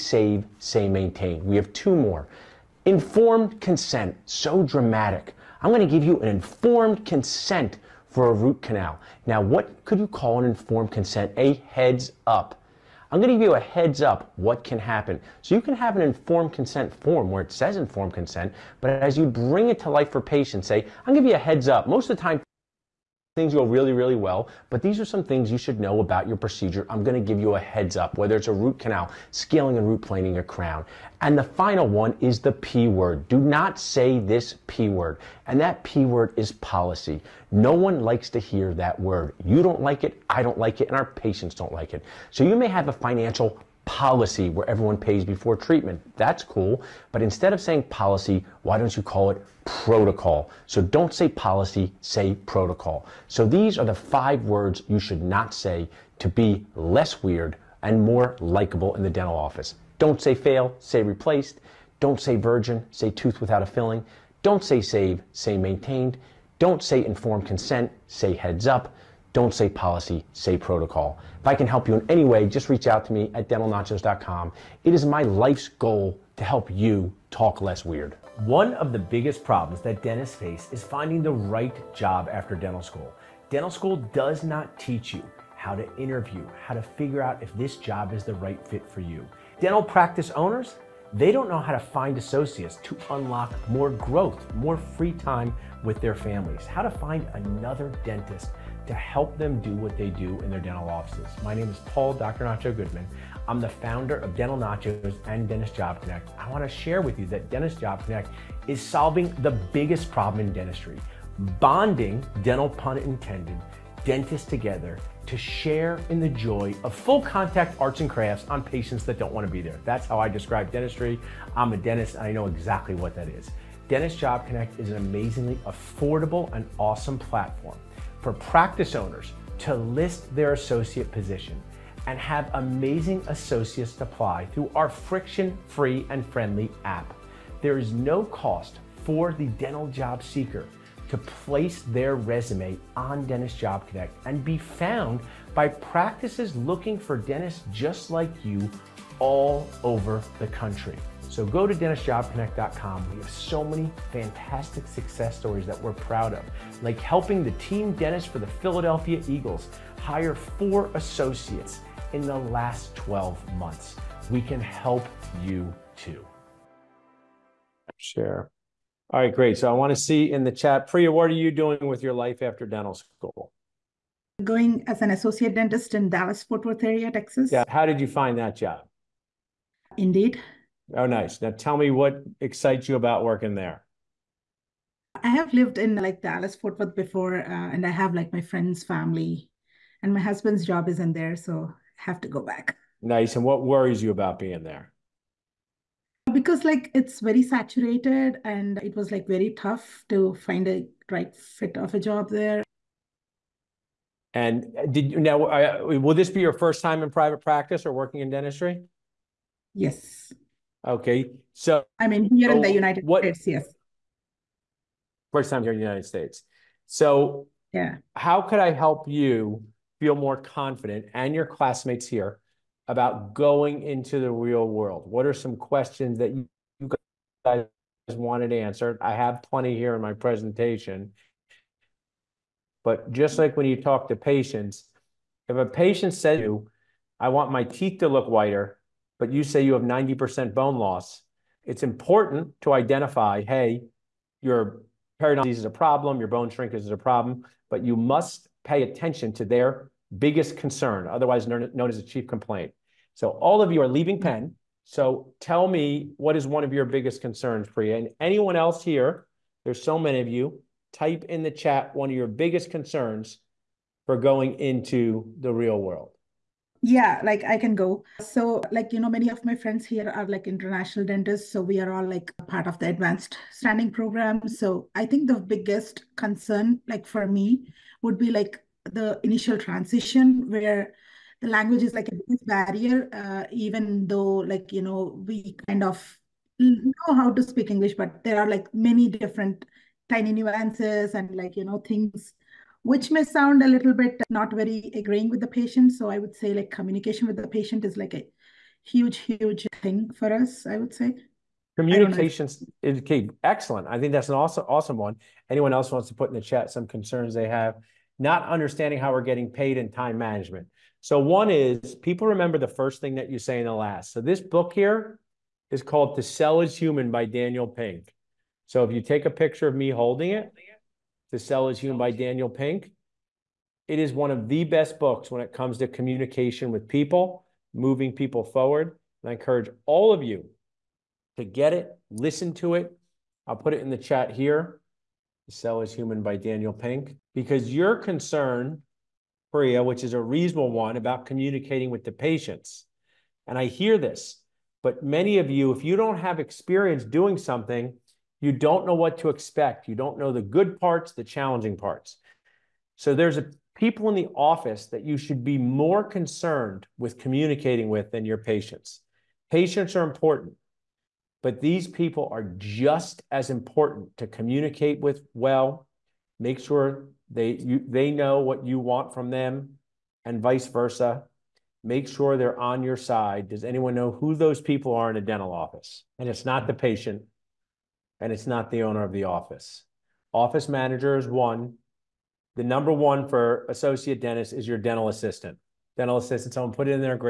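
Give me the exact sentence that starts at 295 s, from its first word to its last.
So I would say like communication with the patient is like a huge, huge thing for us, I would say.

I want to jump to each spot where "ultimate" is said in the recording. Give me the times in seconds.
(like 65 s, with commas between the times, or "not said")
not said.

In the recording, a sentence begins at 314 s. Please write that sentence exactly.
So this book here is called To Sell is Human by Daniel Pink.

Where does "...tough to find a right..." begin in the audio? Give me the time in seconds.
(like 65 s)
199 s.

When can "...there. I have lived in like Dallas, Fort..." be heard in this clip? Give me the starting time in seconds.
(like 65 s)
183 s.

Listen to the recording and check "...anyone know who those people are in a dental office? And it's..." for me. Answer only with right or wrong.
right.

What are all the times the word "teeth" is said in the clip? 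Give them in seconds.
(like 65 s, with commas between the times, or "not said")
237 s.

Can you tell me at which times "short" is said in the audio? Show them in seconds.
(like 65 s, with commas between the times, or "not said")
not said.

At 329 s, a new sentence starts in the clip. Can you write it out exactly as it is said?
And I encourage all of you to get it, listen to it.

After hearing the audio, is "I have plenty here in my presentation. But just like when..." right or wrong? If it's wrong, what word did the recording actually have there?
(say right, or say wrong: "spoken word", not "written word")
right.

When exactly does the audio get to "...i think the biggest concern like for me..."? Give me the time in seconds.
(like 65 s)
274 s.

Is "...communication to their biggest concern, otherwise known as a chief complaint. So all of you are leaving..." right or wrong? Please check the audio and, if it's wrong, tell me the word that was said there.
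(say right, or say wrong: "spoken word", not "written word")
wrong: "attention", not "communication".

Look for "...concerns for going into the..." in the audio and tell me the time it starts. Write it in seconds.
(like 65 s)
262 s.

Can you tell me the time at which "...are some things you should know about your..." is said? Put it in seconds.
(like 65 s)
24 s.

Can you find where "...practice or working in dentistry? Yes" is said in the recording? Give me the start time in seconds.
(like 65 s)
207 s.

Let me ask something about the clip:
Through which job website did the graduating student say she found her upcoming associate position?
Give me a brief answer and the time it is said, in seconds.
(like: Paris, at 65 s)
Indeed, at 179 s.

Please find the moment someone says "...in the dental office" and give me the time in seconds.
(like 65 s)
58 s.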